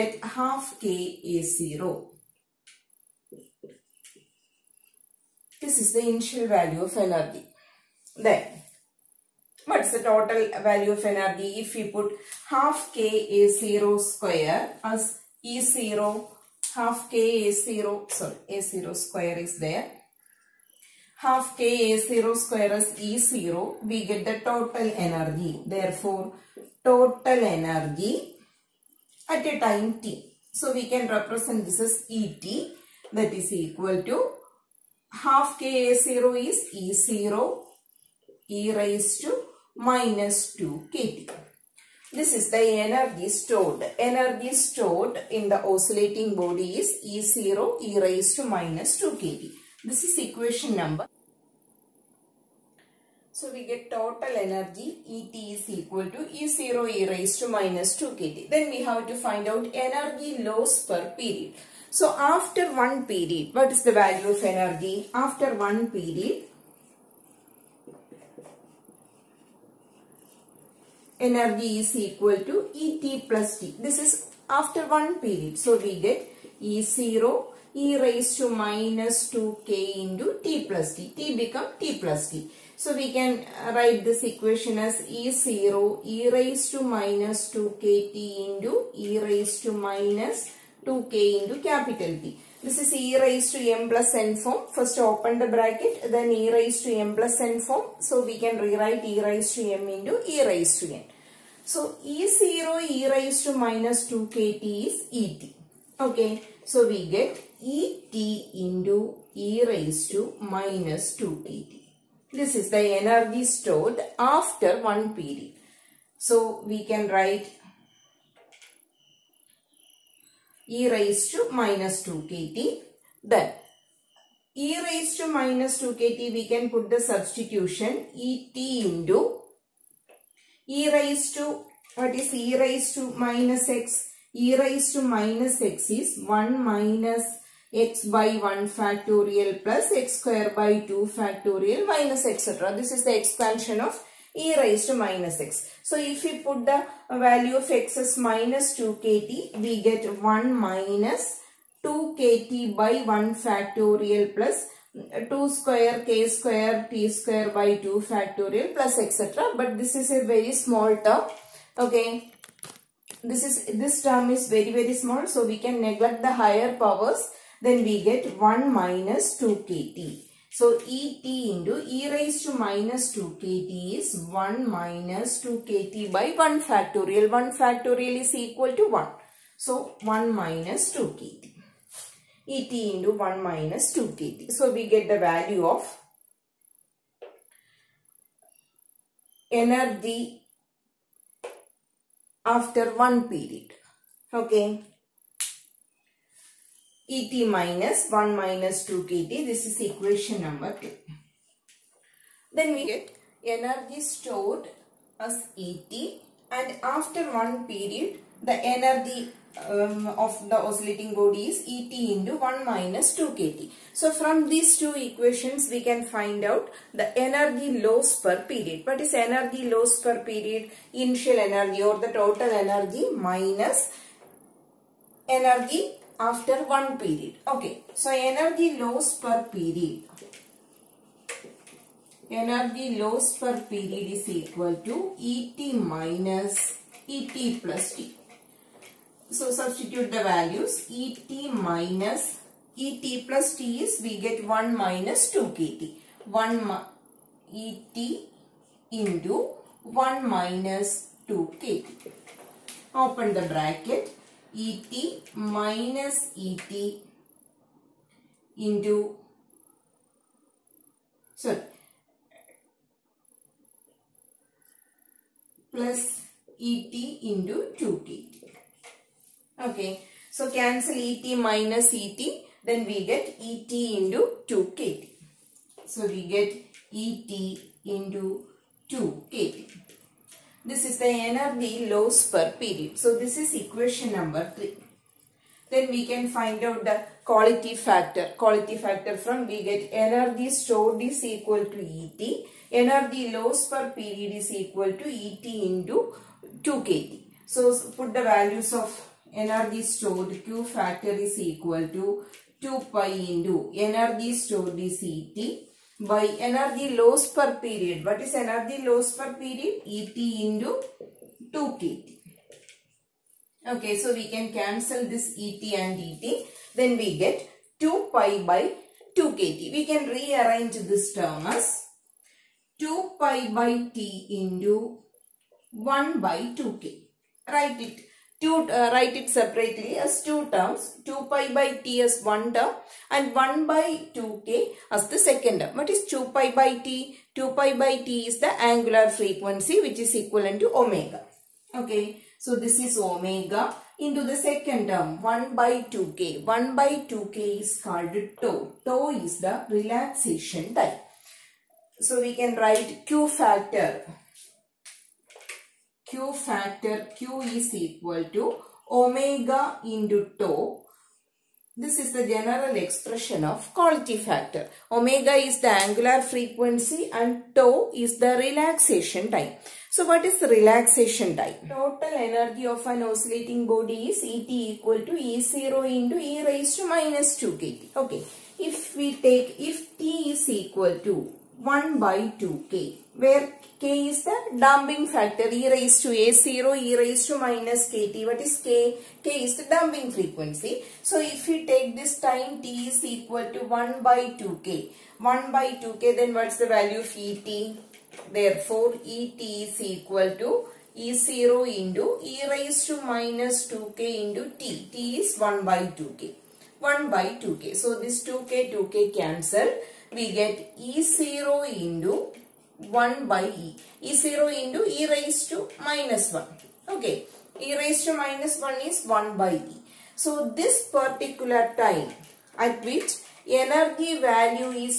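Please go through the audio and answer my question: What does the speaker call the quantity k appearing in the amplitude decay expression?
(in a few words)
damping frequency.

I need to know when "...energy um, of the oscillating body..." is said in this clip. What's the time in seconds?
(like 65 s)
208 s.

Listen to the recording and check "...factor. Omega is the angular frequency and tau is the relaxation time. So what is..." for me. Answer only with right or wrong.
right.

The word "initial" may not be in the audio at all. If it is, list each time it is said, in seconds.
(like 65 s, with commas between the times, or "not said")
6 s, 220 s.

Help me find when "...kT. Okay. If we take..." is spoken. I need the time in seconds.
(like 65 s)
377 s.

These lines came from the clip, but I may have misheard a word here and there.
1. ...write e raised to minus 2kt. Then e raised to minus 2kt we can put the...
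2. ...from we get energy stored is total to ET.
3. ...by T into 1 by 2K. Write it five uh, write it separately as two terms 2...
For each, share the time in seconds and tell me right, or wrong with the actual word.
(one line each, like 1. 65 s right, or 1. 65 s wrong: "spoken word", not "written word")
1. 117 s right
2. 289 s wrong: "equal", not "total"
3. 323 s wrong: "two", not "five".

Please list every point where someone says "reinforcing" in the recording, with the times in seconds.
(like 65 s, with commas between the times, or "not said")
not said.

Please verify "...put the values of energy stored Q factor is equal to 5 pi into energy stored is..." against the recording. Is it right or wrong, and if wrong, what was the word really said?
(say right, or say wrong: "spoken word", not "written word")
wrong: "2", not "5".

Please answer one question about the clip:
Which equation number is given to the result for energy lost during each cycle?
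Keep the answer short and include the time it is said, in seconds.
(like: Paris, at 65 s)
3, at 283 s.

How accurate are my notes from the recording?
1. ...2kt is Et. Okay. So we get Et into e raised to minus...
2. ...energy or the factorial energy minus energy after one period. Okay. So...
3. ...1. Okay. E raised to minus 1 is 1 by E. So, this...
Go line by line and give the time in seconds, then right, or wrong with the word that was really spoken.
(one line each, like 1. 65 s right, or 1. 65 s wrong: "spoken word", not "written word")
1. 104 s right
2. 221 s wrong: "total", not "factorial"
3. 416 s right.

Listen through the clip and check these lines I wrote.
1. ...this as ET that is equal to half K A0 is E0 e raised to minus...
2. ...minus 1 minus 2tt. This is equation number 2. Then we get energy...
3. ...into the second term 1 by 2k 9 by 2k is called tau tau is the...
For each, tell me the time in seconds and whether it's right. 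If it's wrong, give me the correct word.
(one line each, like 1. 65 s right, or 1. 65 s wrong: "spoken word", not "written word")
1. 31 s right
2. 197 s right
3. 344 s wrong: "1", not "9".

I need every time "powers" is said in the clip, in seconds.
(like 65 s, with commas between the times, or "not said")
166 s.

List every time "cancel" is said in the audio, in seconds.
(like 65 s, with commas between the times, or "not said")
270 s, 314 s, 409 s.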